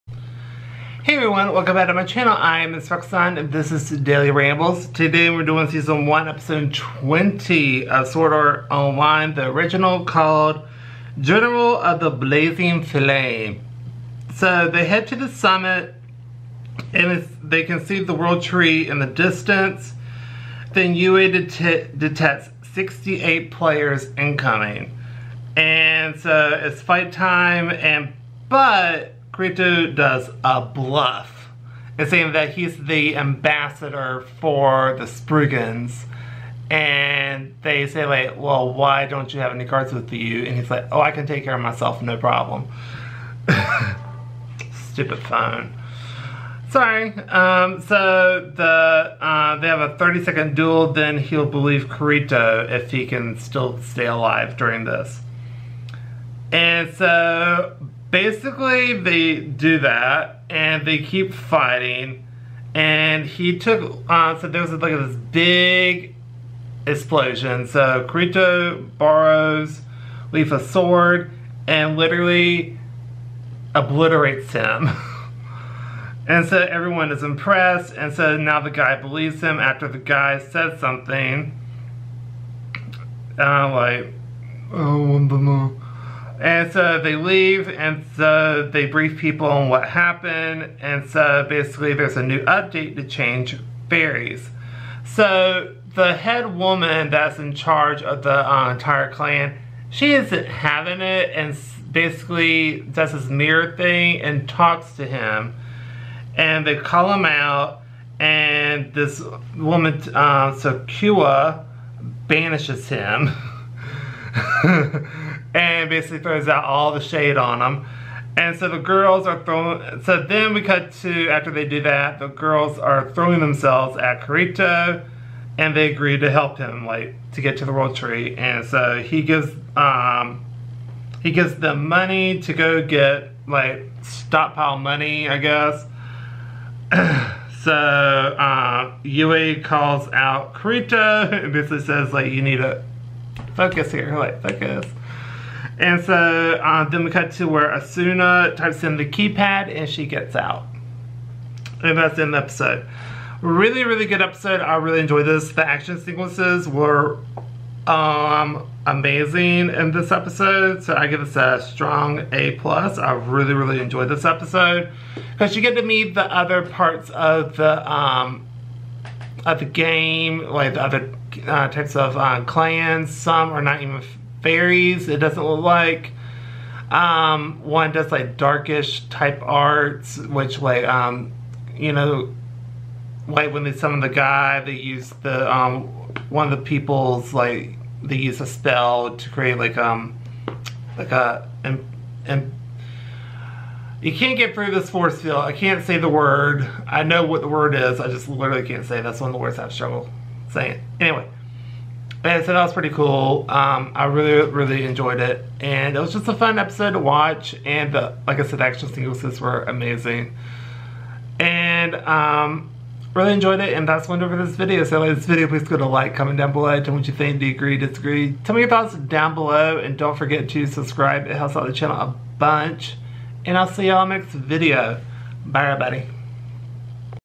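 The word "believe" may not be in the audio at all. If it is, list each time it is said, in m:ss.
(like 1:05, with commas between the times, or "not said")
0:51, 1:19.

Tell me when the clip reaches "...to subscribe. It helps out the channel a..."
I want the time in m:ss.
3:40.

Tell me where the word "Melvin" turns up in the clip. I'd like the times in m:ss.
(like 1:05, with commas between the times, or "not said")
not said.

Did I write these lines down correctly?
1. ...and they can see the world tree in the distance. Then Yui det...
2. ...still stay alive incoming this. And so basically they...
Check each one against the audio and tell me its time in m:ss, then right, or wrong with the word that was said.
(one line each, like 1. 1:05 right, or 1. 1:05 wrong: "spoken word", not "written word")
1. 0:16 right
2. 0:53 wrong: "during", not "incoming".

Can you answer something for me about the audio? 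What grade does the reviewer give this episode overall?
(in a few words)
A plus.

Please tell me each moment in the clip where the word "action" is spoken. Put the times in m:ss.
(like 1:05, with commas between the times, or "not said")
2:35, 3:28.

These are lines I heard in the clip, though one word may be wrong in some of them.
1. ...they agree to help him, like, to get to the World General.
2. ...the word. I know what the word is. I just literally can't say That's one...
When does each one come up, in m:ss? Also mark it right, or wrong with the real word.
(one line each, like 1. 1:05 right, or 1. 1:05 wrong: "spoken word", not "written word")
1. 2:05 wrong: "Tree", not "General"
2. 3:15 right.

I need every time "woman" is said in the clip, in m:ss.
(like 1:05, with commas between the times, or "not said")
1:36, 1:49.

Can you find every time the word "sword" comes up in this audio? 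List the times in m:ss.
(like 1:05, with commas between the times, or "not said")
0:08, 1:10.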